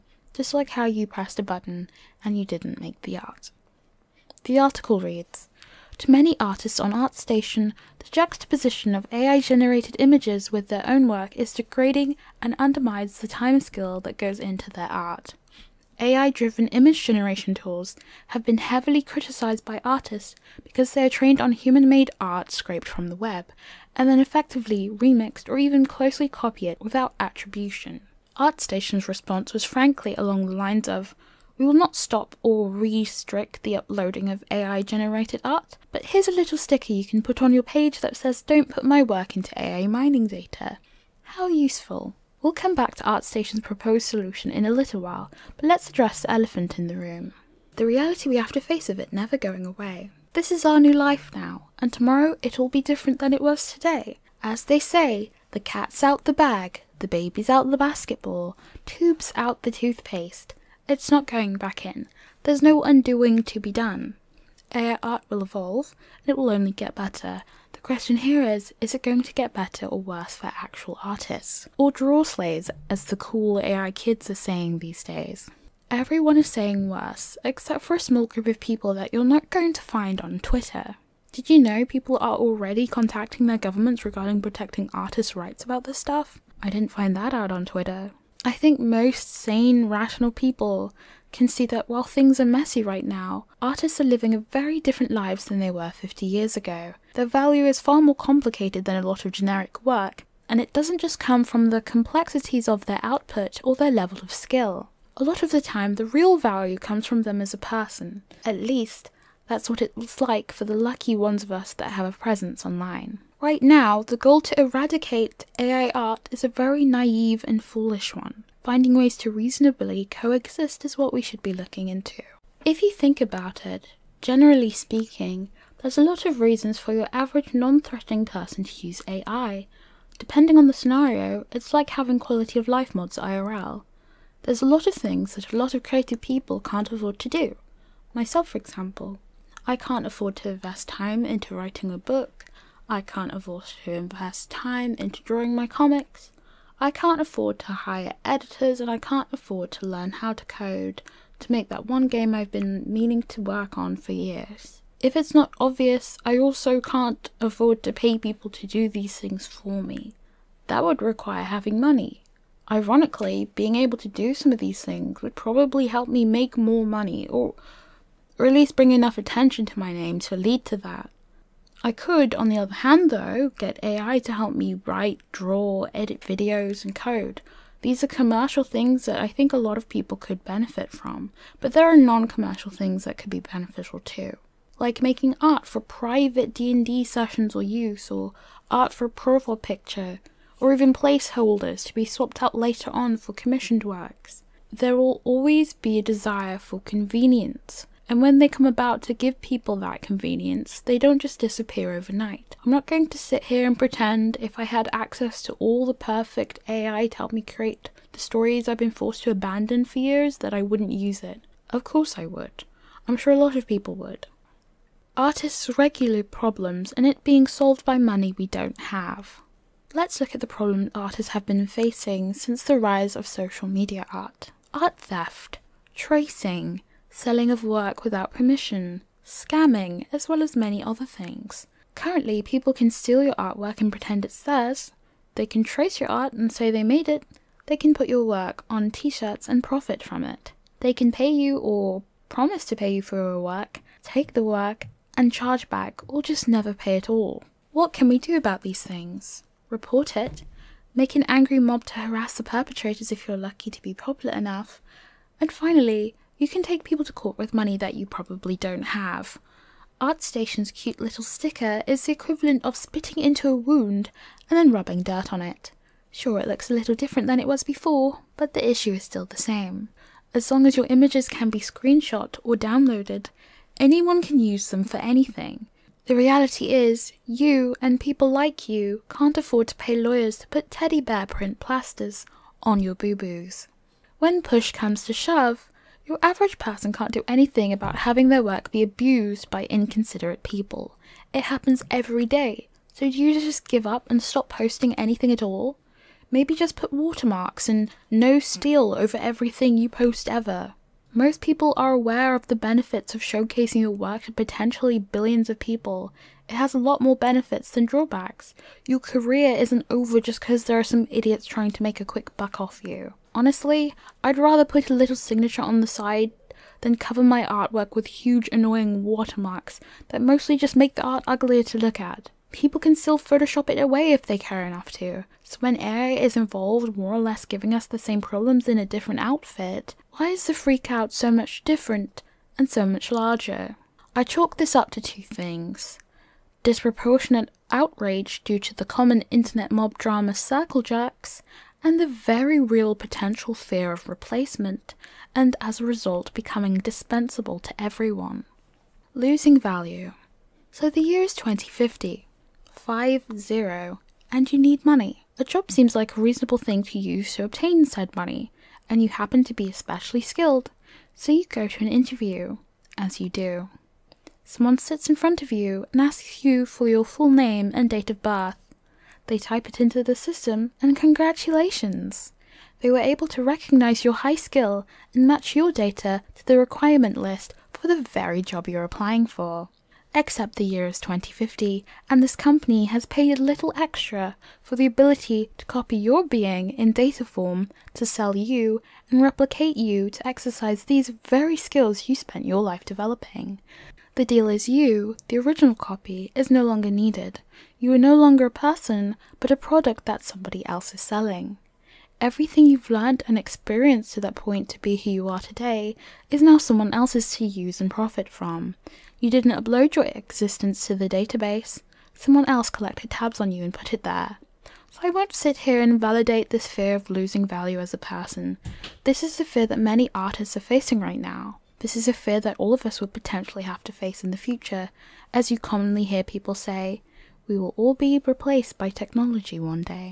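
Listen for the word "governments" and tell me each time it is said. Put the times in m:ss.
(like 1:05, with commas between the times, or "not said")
1:23.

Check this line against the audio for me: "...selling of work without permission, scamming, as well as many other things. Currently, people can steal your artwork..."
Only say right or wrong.
right.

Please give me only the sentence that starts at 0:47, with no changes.
The reality we have to face of it never going away.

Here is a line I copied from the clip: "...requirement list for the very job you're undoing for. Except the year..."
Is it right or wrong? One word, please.
wrong.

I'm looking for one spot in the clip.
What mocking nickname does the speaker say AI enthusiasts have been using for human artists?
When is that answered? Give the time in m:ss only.
1:11.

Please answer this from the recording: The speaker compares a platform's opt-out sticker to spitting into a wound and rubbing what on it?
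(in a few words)
dirt.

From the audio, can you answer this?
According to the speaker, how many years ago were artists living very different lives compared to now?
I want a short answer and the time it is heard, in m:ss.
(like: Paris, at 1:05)
50, at 1:35.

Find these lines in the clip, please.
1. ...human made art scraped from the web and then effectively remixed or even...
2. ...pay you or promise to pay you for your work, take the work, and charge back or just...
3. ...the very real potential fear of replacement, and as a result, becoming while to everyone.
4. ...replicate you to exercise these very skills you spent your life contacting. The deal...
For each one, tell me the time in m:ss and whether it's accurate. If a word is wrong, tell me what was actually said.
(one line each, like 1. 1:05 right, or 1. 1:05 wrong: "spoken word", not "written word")
1. 0:21 right
2. 4:01 right
3. 5:42 wrong: "dispensable", not "while"
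4. 6:29 wrong: "developing", not "contacting".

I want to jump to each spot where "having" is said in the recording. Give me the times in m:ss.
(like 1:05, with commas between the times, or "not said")
2:11, 2:41, 4:48.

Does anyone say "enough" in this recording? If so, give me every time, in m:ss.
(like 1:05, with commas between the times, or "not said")
2:48, 4:14, 5:24.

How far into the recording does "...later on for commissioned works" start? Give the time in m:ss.
3:12.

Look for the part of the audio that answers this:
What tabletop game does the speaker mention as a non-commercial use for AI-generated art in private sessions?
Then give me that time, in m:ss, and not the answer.
3:06.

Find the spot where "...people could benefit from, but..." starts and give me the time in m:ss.
2:59.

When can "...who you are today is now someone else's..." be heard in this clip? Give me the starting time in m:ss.
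6:44.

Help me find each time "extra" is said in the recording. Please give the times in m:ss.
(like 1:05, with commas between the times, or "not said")
6:23.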